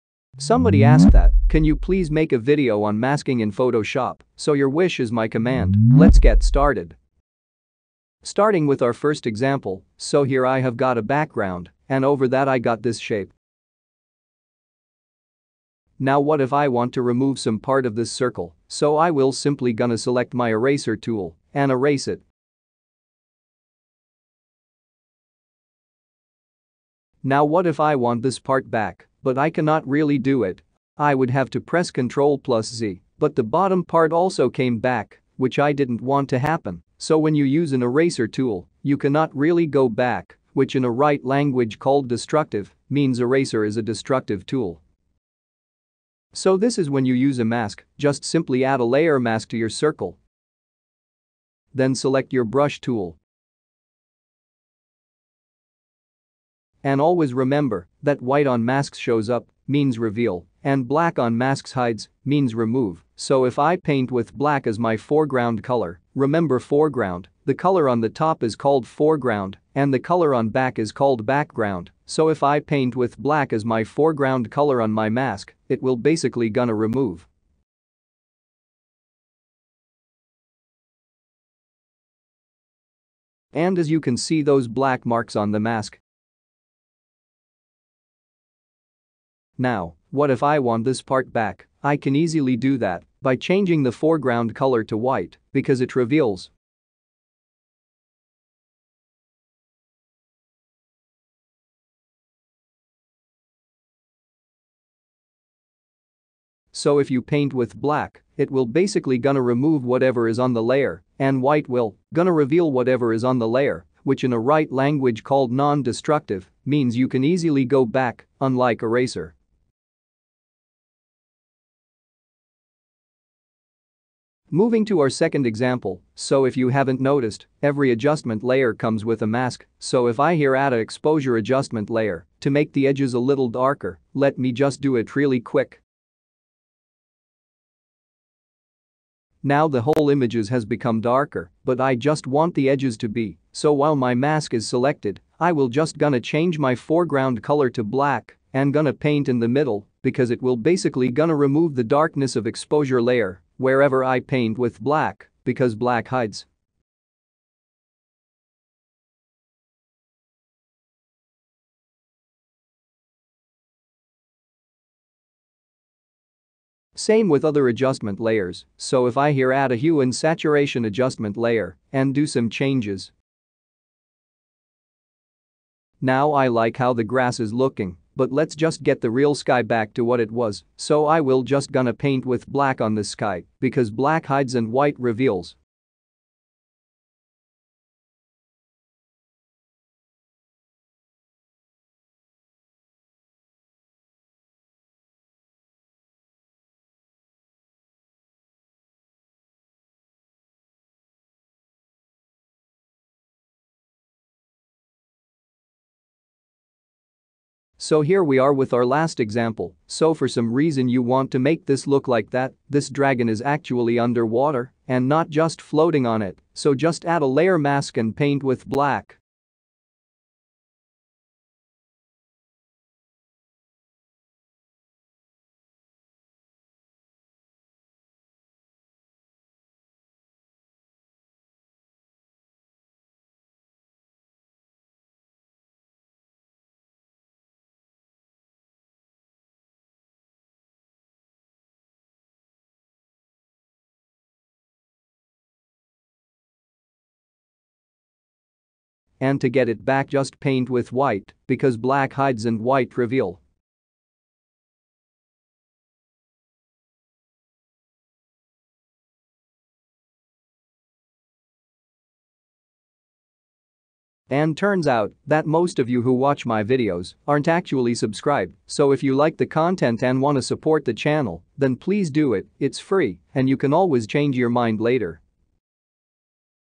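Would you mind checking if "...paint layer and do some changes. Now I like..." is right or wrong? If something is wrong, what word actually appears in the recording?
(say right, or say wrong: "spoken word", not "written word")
wrong: "adjustment", not "paint".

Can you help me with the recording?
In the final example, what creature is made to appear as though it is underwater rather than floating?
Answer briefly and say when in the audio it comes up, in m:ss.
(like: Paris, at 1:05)
dragon, at 3:32.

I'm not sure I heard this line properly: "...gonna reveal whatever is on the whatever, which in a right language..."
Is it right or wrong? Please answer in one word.
wrong.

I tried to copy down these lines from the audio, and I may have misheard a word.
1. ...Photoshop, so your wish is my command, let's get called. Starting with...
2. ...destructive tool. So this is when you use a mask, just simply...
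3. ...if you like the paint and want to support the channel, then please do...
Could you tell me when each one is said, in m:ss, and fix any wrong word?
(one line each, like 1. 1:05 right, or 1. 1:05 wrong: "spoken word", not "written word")
1. 0:03 wrong: "started", not "called"
2. 0:43 right
3. 4:28 wrong: "content", not "paint".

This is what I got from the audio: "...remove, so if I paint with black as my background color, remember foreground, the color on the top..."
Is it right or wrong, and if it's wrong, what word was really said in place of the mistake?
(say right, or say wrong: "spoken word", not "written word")
wrong: "foreground", not "background".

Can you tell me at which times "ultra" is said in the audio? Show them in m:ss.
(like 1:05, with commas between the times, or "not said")
not said.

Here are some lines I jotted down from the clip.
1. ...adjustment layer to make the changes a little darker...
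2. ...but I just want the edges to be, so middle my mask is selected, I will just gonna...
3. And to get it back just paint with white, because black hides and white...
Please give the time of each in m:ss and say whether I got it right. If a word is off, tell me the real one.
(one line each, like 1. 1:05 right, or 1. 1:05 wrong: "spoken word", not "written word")
1. 2:11 wrong: "edges", not "changes"
2. 2:21 wrong: "while", not "middle"
3. 4:09 right.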